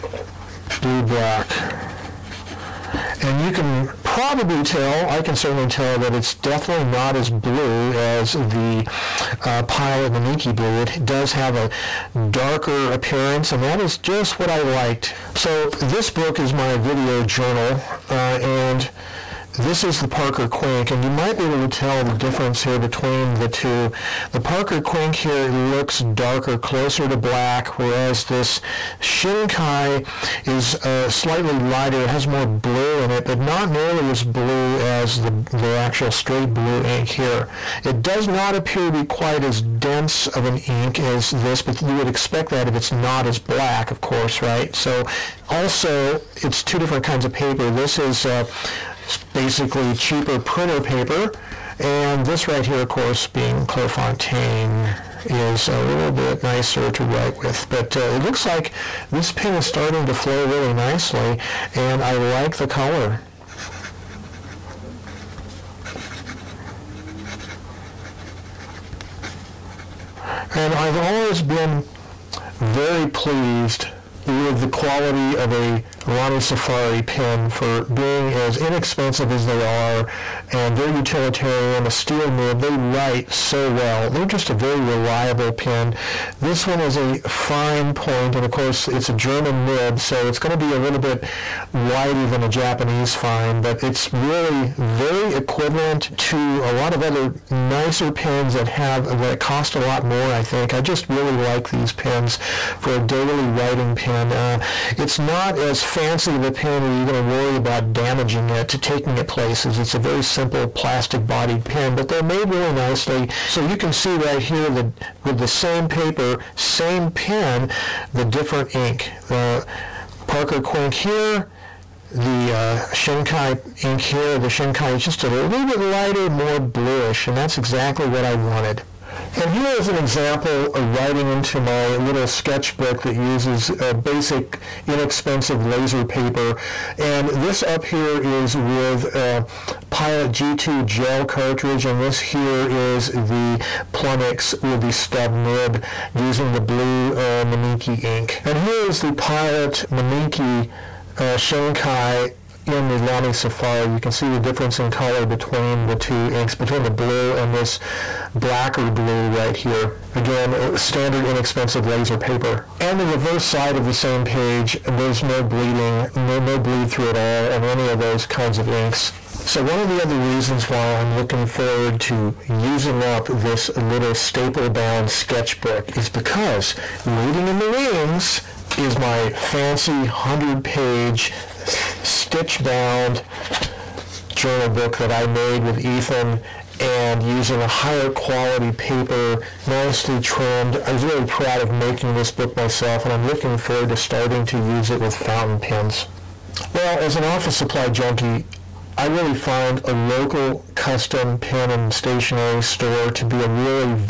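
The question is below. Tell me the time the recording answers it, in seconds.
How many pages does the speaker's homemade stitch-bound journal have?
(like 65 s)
180 s.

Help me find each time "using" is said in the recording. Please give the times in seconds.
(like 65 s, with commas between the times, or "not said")
146 s, 172 s, 187 s.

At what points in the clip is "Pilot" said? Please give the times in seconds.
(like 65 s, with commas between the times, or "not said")
9 s, 139 s, 149 s.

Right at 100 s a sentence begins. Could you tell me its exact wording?
I think I just really like these pens for a daily writing pen.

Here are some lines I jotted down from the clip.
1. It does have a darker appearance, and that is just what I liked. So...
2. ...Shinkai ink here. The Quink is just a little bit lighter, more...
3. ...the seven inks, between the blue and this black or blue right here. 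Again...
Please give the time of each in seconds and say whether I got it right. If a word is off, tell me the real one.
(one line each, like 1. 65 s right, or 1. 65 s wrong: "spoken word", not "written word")
1. 10 s right
2. 123 s wrong: "Shinkai", not "Quink"
3. 155 s wrong: "two", not "seven".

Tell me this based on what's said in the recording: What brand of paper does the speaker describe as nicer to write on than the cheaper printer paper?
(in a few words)
Clairefontaine.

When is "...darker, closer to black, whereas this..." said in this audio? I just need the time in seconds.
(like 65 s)
26 s.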